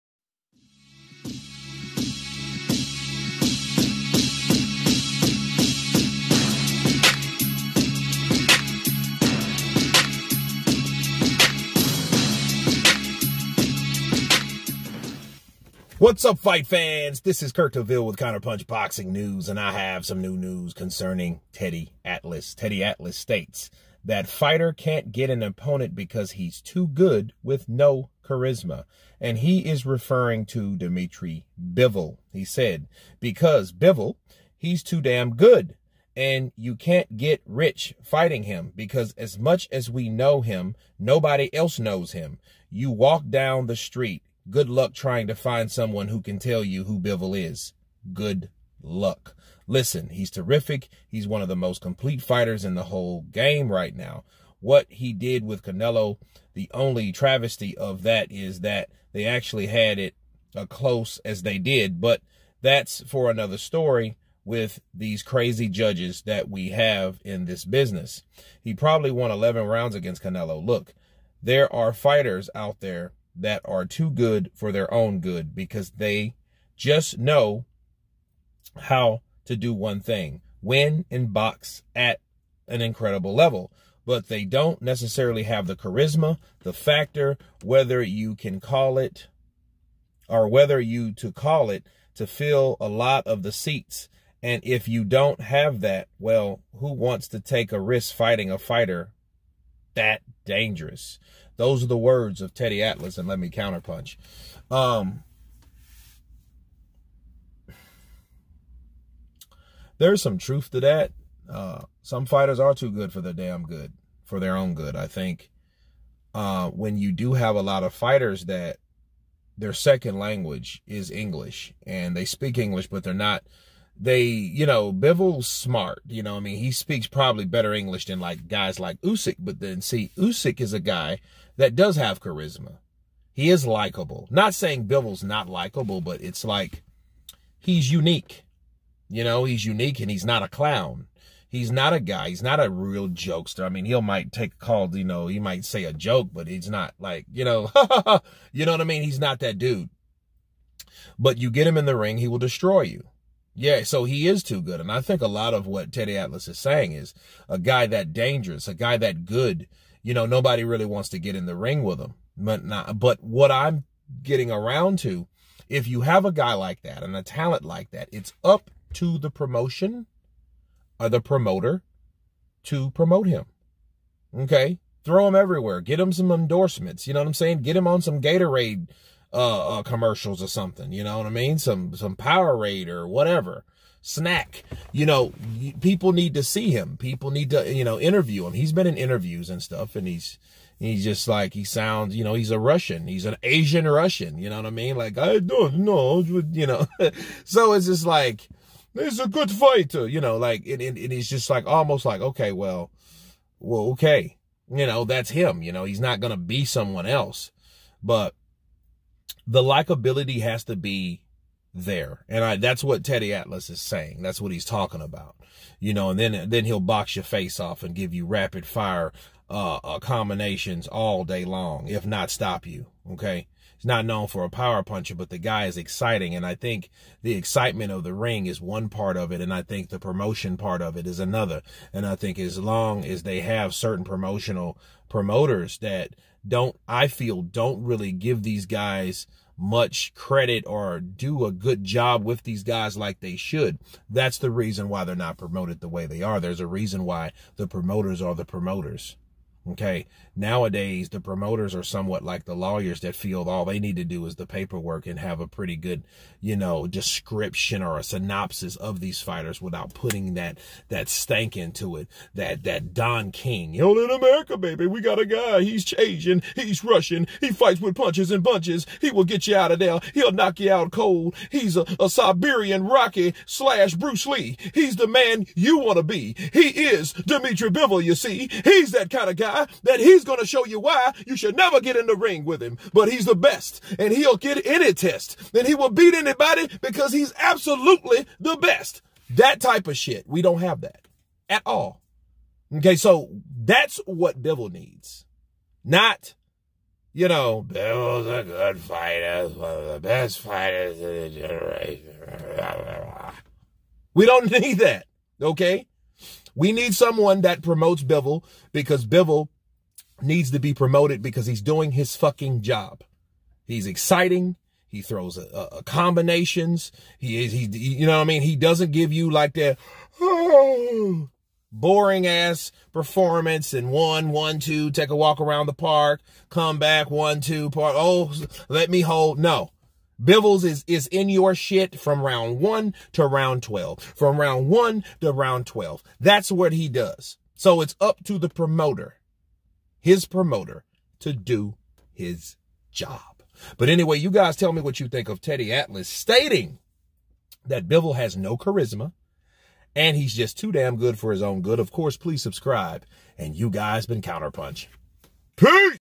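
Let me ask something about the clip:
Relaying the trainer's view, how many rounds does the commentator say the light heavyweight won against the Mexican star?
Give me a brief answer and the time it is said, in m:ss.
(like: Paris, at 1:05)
11, at 1:09.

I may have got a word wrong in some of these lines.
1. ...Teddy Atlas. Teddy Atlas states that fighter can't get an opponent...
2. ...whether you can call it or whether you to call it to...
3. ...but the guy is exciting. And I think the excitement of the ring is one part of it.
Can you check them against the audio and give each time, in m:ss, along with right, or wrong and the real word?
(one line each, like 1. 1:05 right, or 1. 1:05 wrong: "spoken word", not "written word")
1. 0:21 right
2. 1:27 right
3. 3:45 right.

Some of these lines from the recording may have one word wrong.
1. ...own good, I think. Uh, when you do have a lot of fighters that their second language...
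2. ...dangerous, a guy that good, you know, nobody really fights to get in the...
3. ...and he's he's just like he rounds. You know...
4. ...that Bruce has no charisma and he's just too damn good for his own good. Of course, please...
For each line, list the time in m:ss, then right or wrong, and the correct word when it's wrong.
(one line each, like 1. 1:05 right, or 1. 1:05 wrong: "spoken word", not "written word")
1. 1:54 right
2. 2:38 wrong: "wants", not "fights"
3. 3:09 wrong: "sounds", not "rounds"
4. 5:47 wrong: "Bivol", not "Bruce".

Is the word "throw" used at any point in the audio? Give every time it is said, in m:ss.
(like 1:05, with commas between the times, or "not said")
2:55, 5:15.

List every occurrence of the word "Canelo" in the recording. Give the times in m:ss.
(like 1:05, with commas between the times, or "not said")
0:55, 1:10.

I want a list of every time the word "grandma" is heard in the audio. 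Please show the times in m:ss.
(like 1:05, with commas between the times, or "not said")
not said.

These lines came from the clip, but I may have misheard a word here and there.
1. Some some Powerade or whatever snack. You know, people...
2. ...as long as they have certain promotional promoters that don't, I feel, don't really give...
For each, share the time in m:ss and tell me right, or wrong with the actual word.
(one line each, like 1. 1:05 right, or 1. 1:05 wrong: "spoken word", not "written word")
1. 3:01 right
2. 3:52 right.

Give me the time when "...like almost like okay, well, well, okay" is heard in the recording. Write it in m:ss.
3:21.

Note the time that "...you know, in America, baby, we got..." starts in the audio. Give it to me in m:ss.
4:23.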